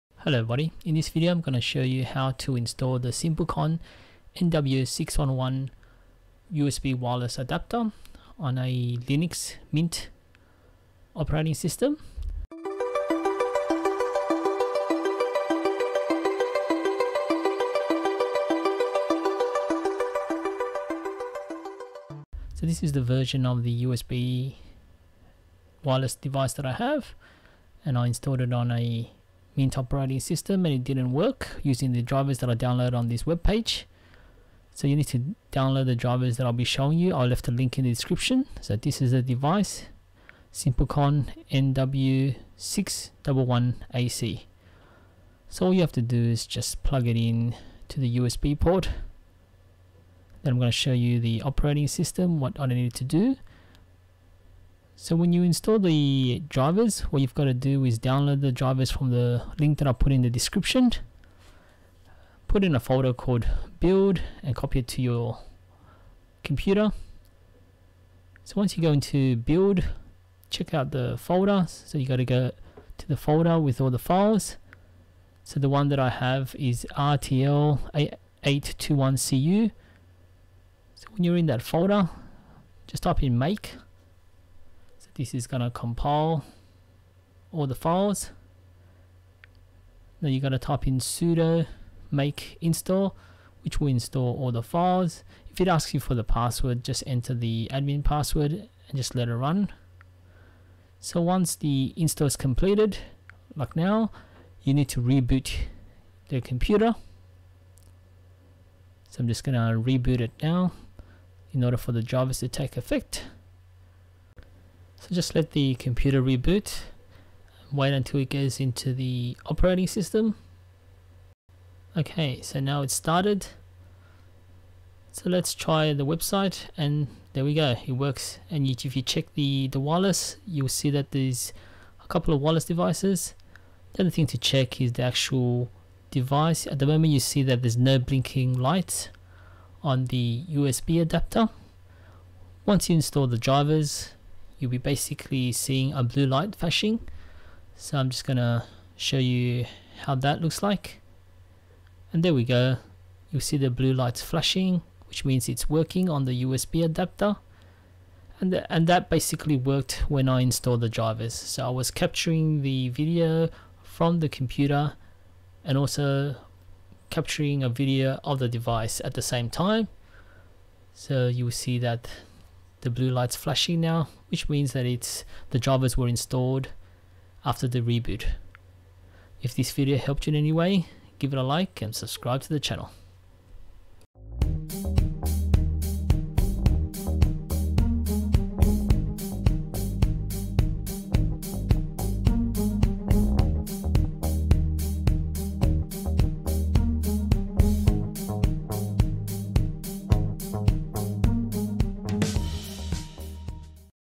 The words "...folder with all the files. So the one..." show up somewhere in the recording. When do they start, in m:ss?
1:13.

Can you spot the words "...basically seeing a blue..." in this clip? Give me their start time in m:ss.
2:24.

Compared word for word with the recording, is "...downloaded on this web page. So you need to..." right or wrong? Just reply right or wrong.
right.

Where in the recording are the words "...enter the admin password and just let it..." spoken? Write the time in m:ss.
1:37.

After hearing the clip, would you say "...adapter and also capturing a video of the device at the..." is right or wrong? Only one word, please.
wrong.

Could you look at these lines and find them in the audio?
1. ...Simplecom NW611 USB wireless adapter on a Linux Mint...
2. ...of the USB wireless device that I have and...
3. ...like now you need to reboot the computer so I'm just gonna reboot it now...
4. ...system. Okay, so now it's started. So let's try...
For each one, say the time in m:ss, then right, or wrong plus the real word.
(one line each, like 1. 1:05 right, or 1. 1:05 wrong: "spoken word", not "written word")
1. 0:03 right
2. 0:23 right
3. 1:43 right
4. 1:59 right.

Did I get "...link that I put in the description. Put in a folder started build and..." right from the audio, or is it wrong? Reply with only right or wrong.
wrong.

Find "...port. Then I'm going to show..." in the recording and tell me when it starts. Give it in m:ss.
0:48.